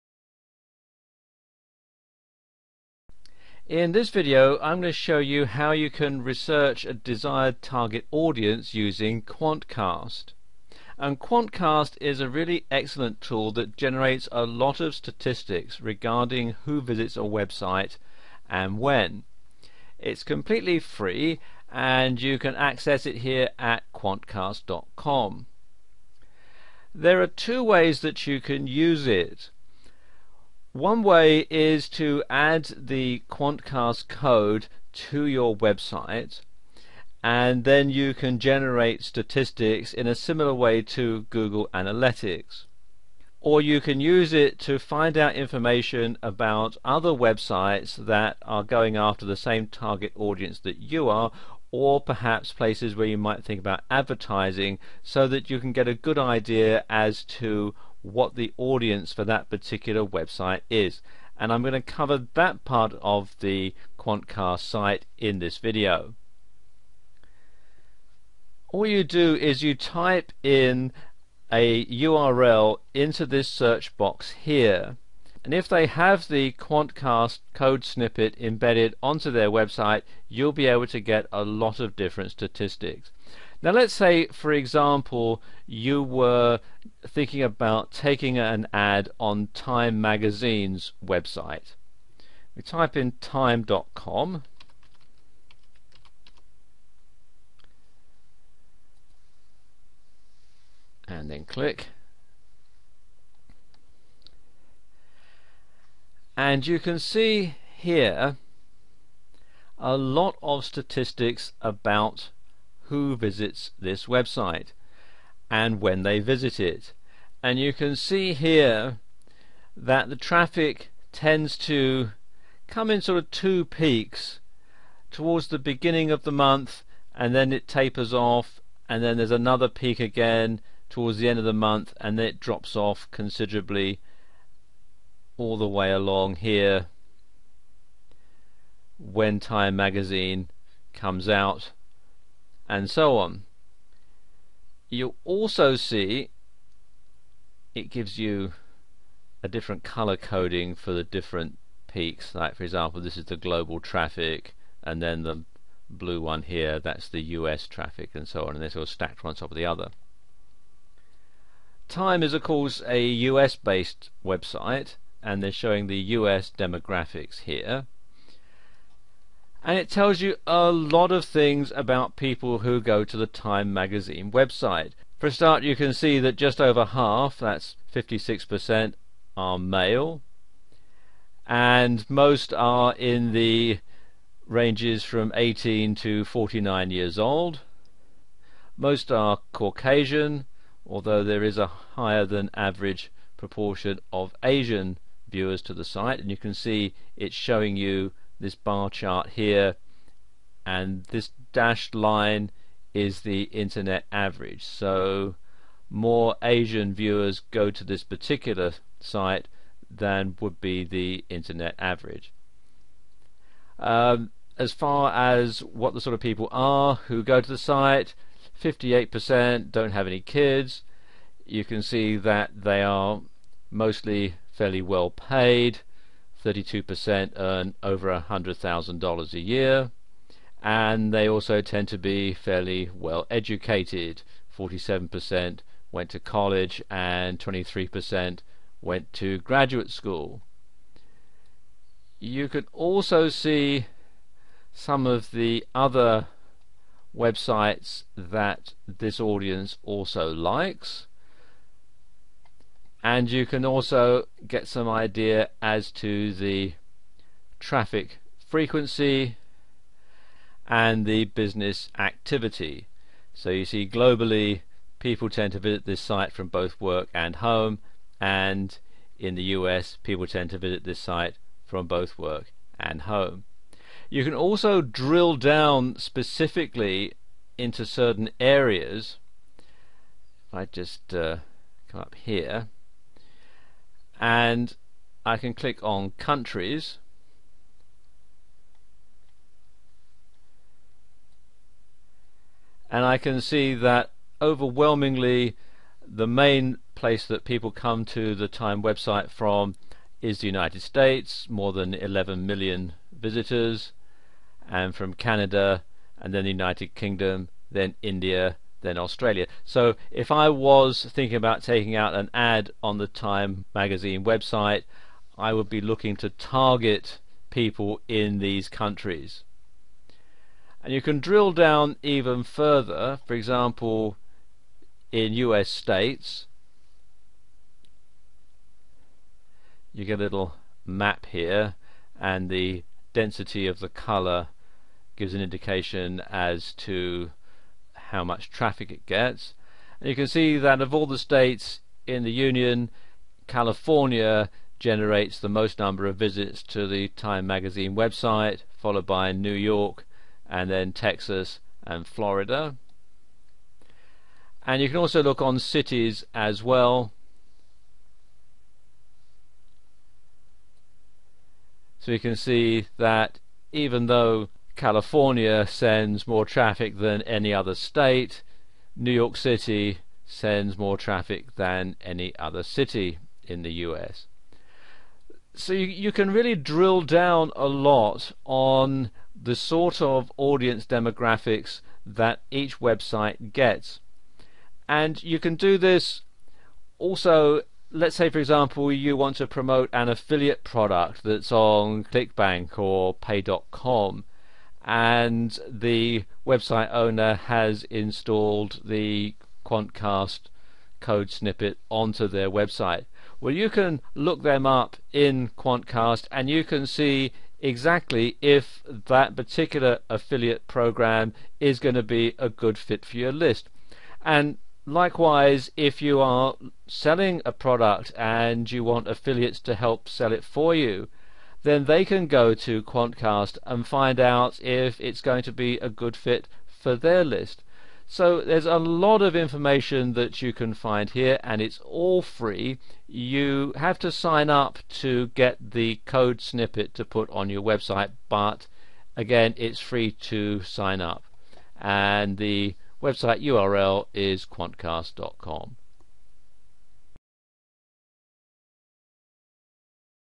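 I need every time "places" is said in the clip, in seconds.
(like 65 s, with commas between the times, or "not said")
52 s, 296 s.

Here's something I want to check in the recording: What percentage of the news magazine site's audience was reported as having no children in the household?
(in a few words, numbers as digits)
58%.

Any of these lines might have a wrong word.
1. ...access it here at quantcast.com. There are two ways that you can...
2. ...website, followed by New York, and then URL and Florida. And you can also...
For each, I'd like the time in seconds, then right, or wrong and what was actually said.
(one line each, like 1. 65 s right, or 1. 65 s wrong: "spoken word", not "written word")
1. 22 s right
2. 347 s wrong: "Texas", not "URL".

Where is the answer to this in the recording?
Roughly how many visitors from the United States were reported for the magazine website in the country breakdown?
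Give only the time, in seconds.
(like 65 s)
301 s.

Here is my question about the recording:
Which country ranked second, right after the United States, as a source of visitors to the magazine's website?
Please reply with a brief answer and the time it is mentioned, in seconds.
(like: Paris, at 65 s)
Canada, at 305 s.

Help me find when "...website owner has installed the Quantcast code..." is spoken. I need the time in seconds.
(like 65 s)
396 s.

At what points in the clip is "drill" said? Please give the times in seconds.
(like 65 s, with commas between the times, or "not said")
274 s, 321 s, 376 s.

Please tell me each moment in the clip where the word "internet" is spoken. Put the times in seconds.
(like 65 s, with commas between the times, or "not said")
203 s, 211 s.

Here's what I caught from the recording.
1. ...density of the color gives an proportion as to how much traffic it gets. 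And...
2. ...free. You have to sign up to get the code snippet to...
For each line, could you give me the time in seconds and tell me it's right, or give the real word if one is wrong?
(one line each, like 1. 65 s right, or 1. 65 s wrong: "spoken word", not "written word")
1. 333 s wrong: "indication", not "proportion"
2. 432 s right.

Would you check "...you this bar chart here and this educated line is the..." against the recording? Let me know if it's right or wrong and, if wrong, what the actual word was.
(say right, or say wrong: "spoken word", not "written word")
wrong: "dashed", not "educated".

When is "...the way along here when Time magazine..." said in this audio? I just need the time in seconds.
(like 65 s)
135 s.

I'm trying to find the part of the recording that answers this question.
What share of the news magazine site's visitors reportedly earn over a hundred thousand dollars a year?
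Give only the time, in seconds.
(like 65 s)
226 s.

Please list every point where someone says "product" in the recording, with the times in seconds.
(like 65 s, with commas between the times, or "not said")
390 s, 417 s.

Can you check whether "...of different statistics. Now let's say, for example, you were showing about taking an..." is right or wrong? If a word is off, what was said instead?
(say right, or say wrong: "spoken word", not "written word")
wrong: "thinking", not "showing".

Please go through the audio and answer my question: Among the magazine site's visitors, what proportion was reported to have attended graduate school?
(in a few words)
23%.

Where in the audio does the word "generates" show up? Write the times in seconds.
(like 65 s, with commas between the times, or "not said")
13 s, 38 s, 344 s.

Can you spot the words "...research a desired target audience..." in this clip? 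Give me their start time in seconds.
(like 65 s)
6 s.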